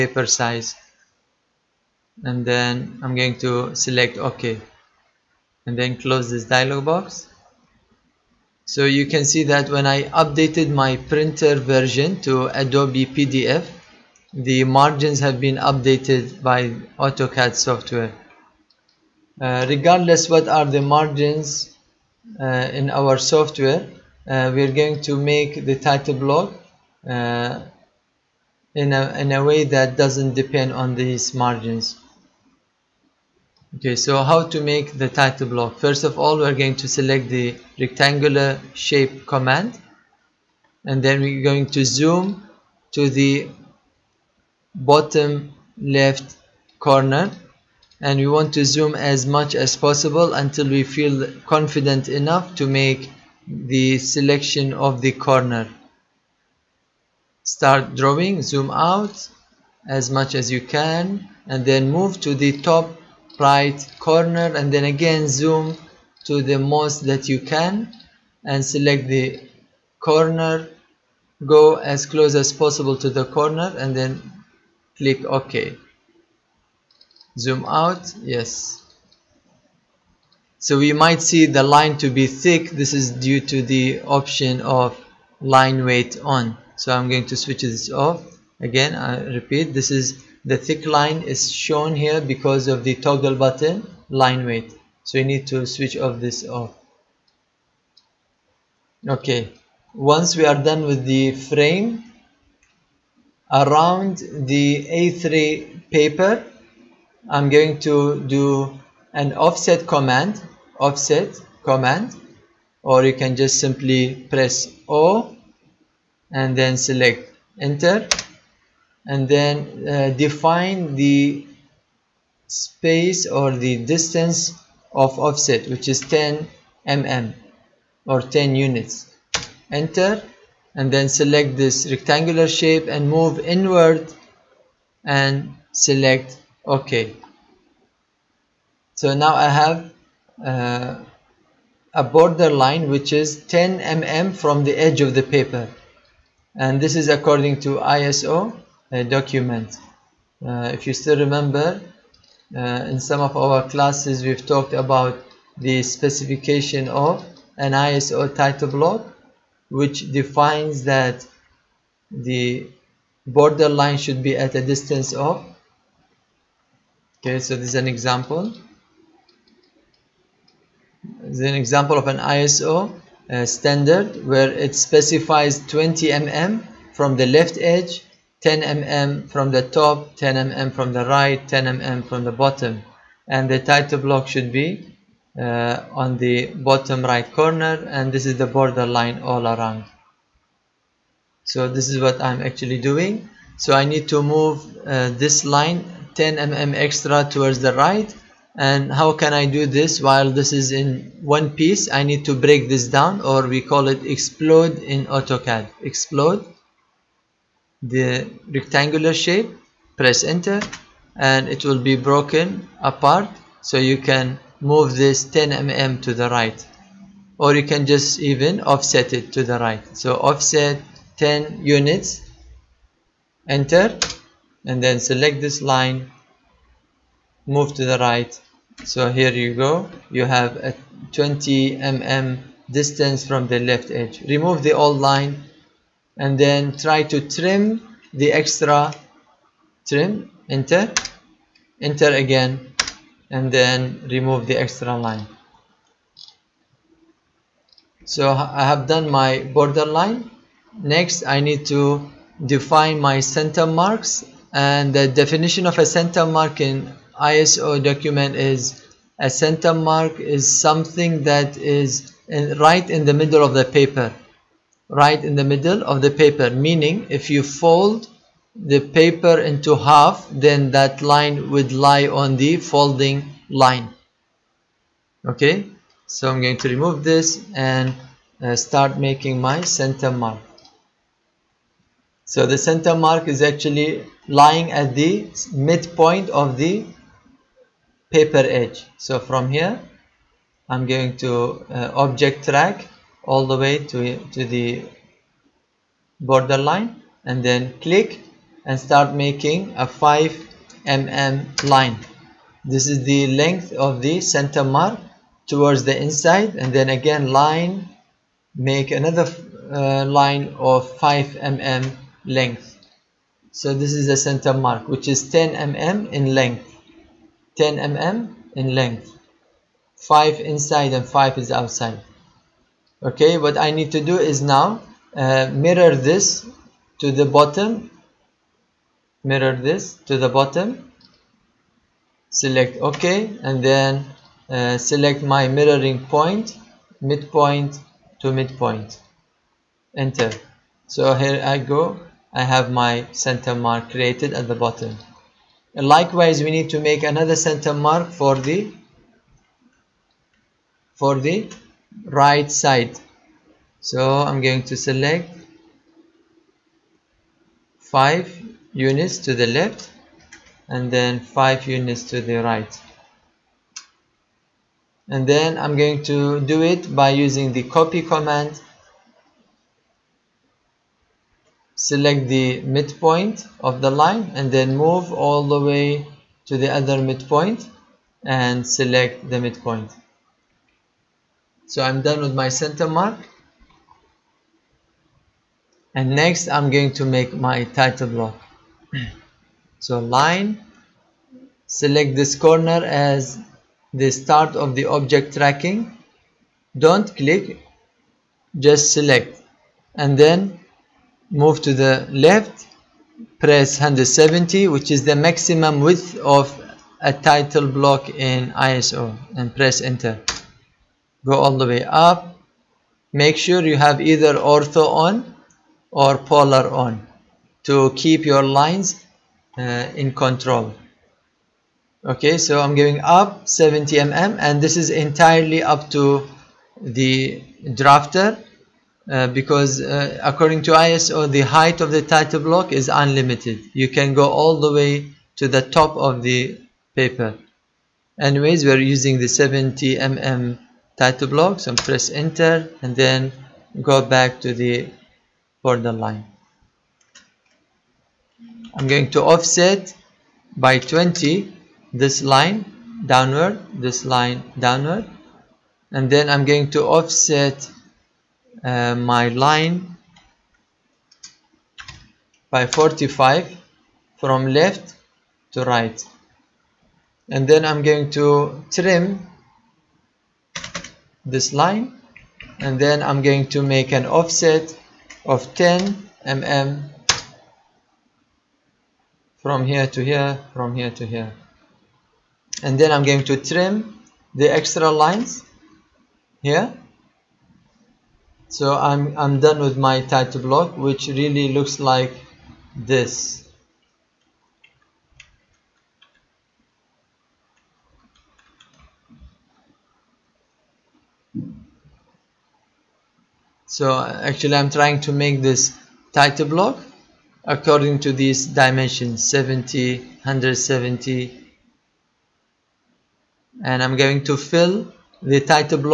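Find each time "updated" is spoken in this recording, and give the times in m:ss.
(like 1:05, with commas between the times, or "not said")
0:10, 0:15.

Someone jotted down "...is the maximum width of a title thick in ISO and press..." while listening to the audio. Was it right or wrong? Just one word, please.
wrong.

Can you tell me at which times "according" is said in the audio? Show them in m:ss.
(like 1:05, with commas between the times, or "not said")
2:27, 7:10, 8:27.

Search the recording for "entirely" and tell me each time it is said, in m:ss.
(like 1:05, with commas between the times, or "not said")
7:05.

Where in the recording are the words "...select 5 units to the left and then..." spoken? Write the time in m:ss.
5:54.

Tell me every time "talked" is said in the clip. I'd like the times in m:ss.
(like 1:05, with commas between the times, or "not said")
2:34.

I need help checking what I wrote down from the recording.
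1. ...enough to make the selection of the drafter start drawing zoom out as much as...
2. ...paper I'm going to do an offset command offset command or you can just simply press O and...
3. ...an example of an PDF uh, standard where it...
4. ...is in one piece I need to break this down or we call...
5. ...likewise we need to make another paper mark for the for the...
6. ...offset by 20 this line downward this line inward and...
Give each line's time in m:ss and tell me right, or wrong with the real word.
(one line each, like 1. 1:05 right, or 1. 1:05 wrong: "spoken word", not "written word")
1. 0:52 wrong: "corner", not "drafter"
2. 1:45 right
3. 2:51 wrong: "ISO", not "PDF"
4. 3:20 right
5. 5:45 wrong: "center", not "paper"
6. 7:29 wrong: "downward", not "inward".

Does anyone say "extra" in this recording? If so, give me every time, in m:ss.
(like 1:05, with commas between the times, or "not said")
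3:16, 3:58, 4:04, 8:04.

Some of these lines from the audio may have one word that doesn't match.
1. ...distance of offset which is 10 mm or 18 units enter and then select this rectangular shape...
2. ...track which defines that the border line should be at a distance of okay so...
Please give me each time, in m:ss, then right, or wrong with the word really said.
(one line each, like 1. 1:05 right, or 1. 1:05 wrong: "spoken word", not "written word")
1. 2:03 wrong: "10", not "18"
2. 2:38 wrong: "block", not "track".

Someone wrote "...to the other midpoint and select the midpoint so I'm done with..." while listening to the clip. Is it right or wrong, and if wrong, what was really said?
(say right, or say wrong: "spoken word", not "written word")
right.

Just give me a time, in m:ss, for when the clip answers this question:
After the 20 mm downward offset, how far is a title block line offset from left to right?
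7:42.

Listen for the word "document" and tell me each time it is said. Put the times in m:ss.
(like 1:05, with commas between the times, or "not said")
2:29, 4:17.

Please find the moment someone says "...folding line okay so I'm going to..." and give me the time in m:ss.
4:32.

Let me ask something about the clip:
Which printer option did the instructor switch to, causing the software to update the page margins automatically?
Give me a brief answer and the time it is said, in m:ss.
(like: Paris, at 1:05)
Adobe PDF, at 0:12.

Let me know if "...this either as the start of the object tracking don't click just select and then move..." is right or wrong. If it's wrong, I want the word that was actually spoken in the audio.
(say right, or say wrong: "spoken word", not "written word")
wrong: "corner", not "either".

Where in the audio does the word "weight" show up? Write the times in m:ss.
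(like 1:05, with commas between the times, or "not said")
1:25, 1:34.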